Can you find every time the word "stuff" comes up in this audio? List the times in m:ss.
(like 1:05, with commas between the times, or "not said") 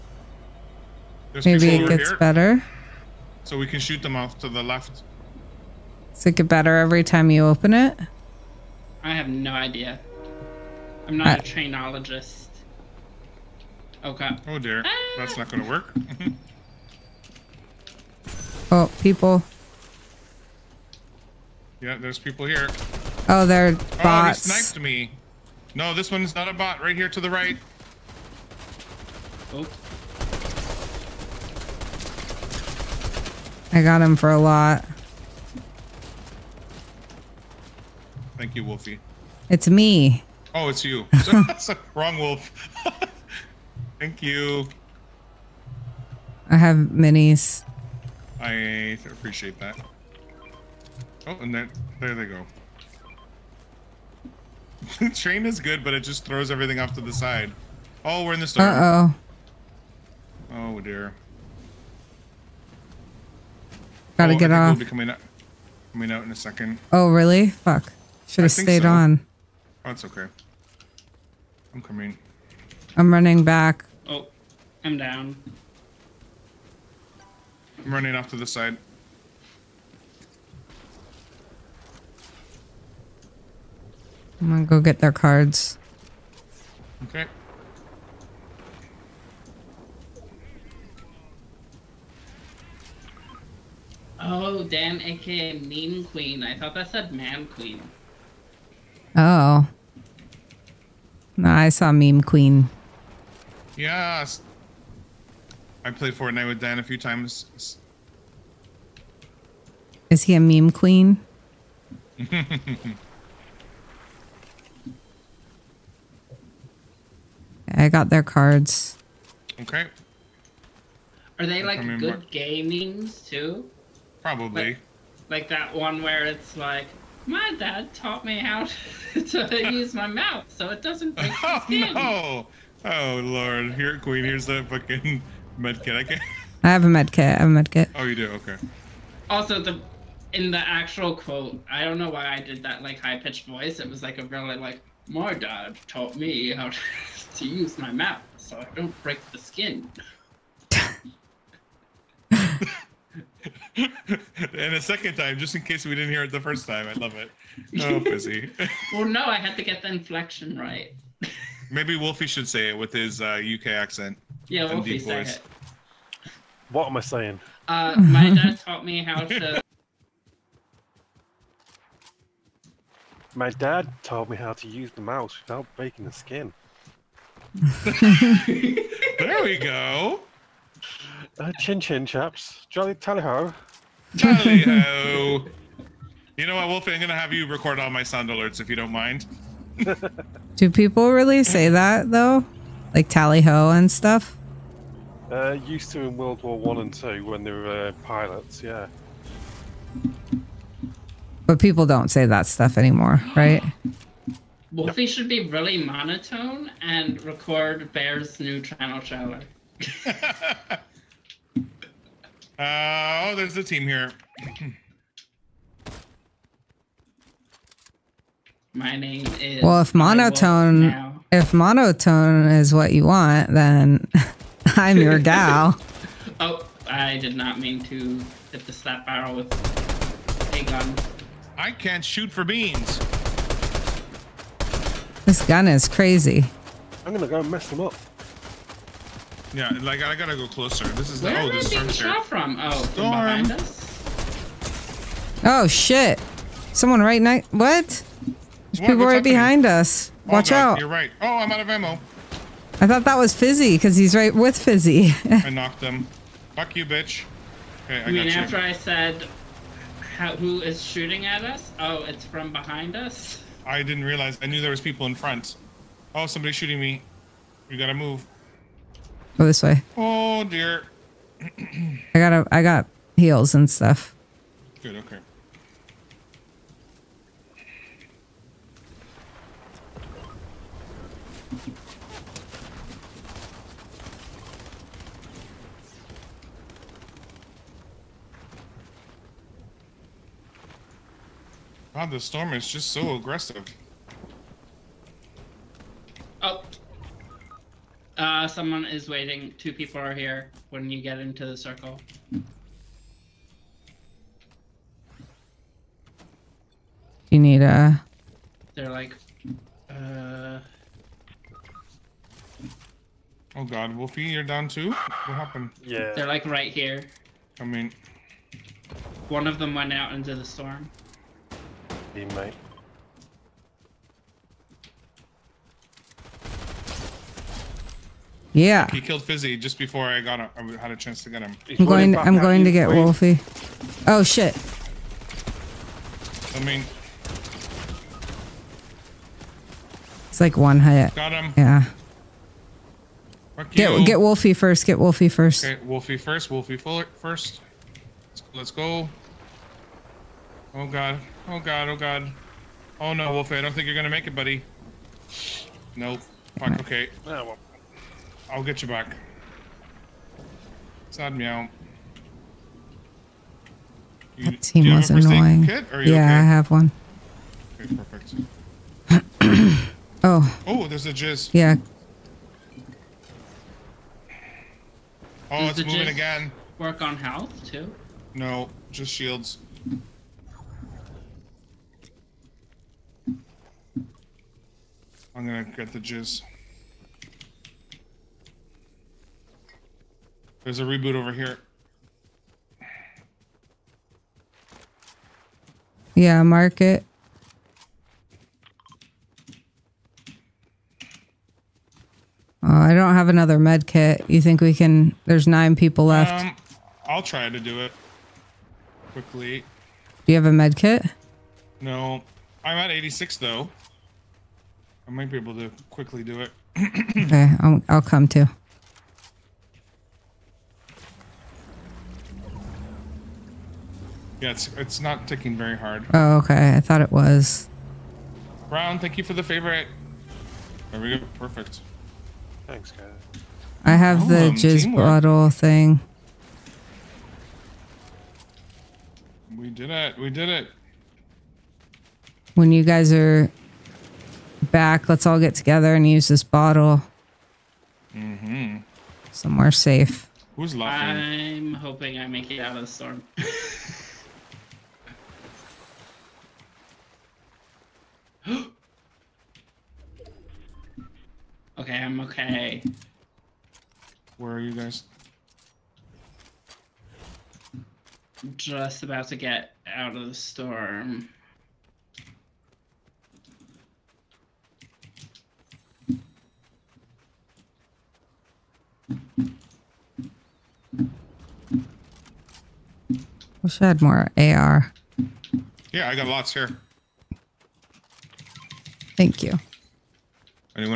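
3:13, 3:22, 4:33.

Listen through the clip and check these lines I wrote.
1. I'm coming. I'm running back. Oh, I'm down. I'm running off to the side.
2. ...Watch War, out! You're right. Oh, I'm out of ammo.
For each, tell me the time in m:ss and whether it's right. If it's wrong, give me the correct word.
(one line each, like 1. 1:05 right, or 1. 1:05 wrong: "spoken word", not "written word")
1. 1:11 right
2. 4:10 wrong: "God", not "War".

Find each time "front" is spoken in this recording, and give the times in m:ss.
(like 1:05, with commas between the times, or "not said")
4:25.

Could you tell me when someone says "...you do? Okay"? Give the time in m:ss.
2:18.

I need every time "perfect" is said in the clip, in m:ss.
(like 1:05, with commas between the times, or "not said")
6:07, 7:11.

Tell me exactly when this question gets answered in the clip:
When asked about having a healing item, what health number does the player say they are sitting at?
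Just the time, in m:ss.
6:52.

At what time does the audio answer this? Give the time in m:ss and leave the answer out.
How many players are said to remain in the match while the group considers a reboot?
6:45.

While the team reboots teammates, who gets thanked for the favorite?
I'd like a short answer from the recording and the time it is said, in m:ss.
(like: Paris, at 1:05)
Brown, at 7:08.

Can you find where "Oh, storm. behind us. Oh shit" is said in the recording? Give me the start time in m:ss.
4:02.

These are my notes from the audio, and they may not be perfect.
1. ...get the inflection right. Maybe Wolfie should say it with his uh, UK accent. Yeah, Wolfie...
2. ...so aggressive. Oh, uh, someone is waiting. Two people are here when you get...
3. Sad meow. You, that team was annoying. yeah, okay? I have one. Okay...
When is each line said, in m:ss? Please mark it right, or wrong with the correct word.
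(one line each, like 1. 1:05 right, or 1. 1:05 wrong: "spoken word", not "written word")
1. 2:39 right
2. 4:52 right
3. 6:01 right.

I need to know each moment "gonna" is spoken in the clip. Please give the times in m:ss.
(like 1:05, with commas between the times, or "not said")
0:15, 1:24, 3:57, 5:53, 6:25.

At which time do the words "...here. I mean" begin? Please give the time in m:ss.
5:16.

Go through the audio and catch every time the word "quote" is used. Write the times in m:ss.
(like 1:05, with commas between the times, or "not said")
2:21.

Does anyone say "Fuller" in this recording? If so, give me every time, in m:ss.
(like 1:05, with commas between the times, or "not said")
5:46.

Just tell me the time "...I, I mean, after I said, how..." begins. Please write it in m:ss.
4:18.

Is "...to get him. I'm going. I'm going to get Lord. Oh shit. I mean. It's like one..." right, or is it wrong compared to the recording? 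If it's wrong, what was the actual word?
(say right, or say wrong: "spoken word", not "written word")
wrong: "Wolfie", not "Lord".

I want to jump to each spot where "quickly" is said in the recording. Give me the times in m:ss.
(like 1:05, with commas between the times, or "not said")
6:49, 6:55.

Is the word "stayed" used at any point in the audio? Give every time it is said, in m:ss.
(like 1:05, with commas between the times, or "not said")
1:08.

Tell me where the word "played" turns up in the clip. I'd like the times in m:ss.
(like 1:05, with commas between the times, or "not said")
1:45.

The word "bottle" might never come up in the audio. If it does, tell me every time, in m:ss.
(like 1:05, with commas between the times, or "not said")
7:15, 7:26.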